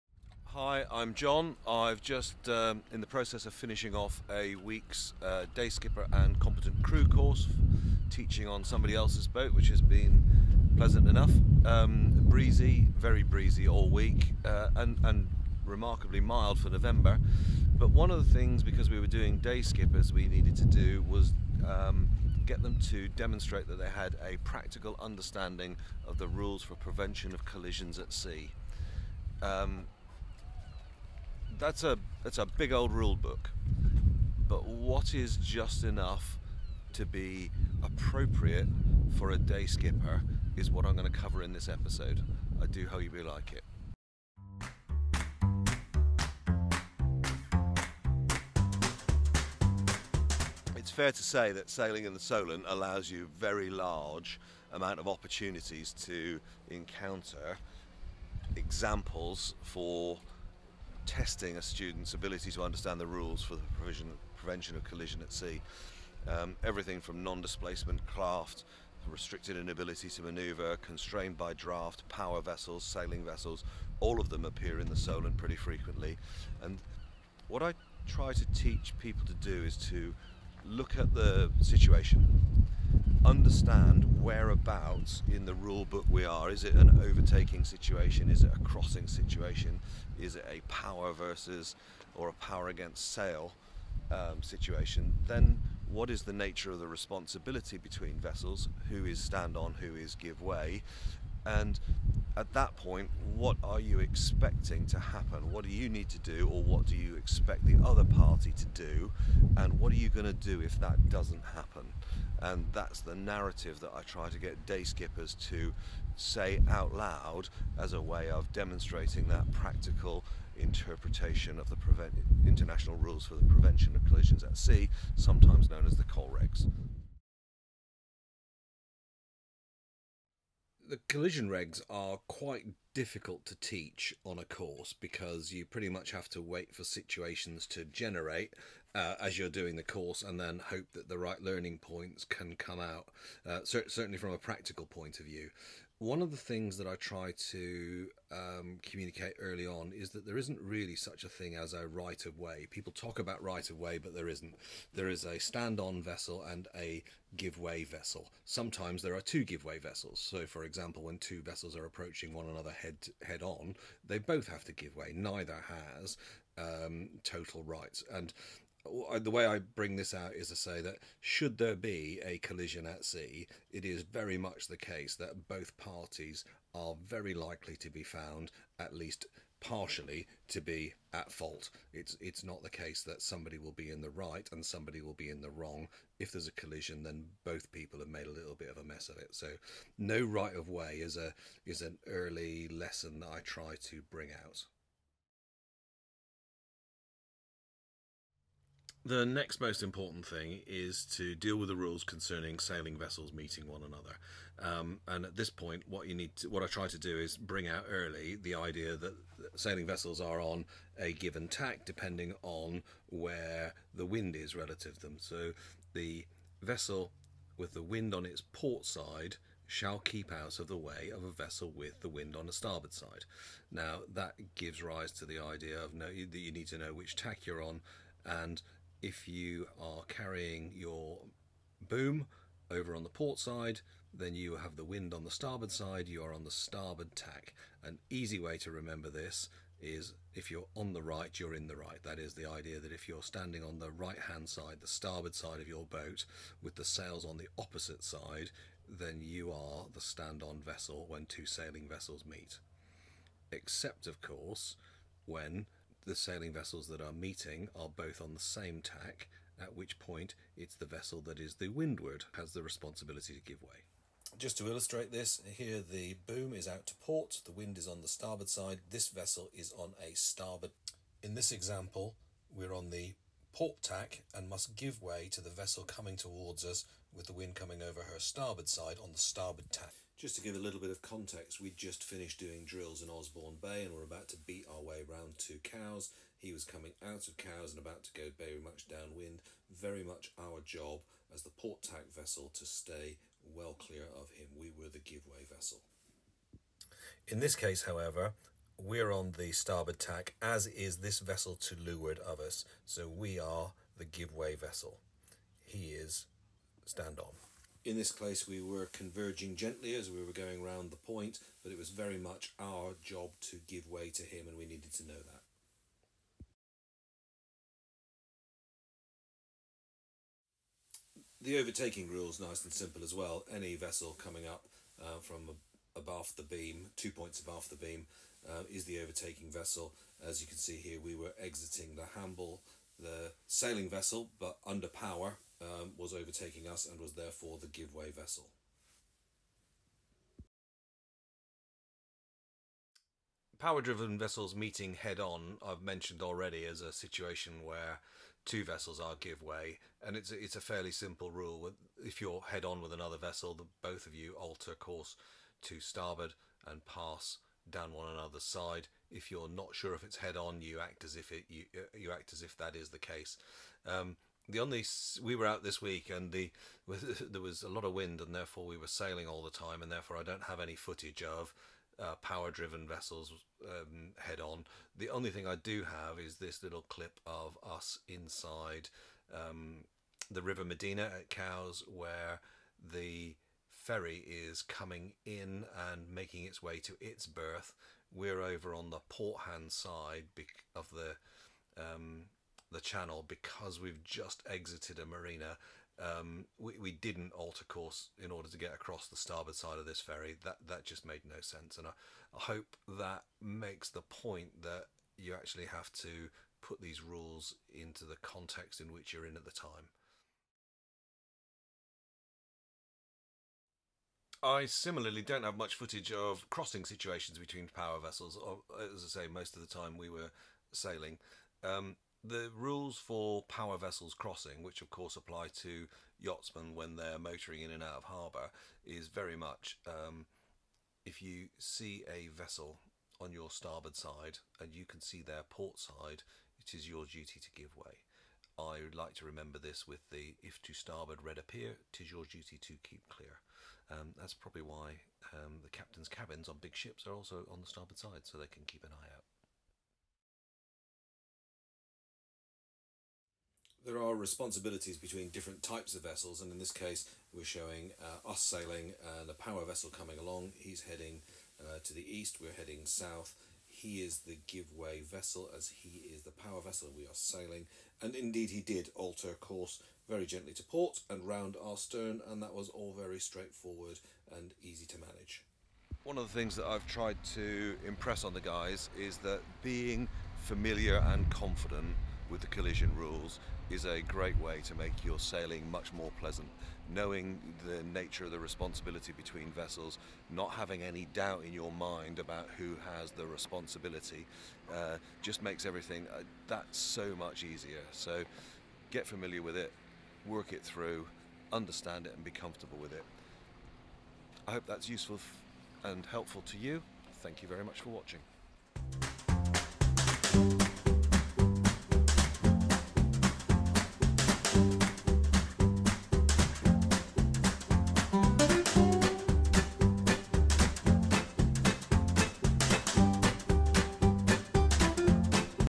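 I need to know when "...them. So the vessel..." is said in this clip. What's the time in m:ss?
3:35.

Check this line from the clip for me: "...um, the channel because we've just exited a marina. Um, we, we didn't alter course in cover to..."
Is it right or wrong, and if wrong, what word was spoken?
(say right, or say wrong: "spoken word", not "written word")
wrong: "order", not "cover".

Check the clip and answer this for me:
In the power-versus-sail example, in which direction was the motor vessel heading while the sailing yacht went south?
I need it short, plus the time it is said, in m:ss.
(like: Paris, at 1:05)
East, at 7:42.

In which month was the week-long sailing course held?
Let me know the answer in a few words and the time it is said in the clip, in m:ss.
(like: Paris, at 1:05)
November, at 0:16.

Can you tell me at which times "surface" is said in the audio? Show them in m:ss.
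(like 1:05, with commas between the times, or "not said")
not said.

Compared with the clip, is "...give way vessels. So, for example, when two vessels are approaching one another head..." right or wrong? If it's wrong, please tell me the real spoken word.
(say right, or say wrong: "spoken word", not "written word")
right.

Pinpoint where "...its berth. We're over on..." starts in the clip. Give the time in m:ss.
6:26.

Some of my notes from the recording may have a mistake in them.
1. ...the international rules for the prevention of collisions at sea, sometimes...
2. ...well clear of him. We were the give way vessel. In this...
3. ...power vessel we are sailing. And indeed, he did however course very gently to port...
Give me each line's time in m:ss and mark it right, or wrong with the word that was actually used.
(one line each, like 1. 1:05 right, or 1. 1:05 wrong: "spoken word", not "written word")
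1. 2:01 right
2. 4:53 right
3. 7:46 wrong: "alter", not "however".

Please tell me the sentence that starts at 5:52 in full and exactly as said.
If you're head on with another vessel, the, both of you alter course to starboard and pass down one another's side.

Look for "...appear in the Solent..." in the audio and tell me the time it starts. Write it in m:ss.
1:14.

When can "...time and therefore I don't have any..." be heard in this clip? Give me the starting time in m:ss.
6:09.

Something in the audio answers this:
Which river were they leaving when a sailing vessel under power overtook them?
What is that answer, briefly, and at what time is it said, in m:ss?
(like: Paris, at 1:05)
The Hamble, at 5:32.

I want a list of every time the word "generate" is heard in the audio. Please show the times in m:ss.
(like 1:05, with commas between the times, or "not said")
2:17.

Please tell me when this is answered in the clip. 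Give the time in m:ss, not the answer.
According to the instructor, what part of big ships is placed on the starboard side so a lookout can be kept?
7:25.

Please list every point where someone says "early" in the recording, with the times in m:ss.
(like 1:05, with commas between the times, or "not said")
2:29, 3:12, 3:27.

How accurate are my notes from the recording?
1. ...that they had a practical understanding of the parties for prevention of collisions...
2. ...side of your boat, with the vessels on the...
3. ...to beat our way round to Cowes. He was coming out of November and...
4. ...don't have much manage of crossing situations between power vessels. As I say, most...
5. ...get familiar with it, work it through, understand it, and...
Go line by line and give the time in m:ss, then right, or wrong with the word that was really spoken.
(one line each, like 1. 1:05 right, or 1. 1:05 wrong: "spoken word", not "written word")
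1. 0:23 wrong: "rules", not "parties"
2. 4:05 wrong: "sails", not "vessels"
3. 4:44 wrong: "Cowes", not "November"
4. 6:55 wrong: "footage", not "manage"
5. 8:18 right.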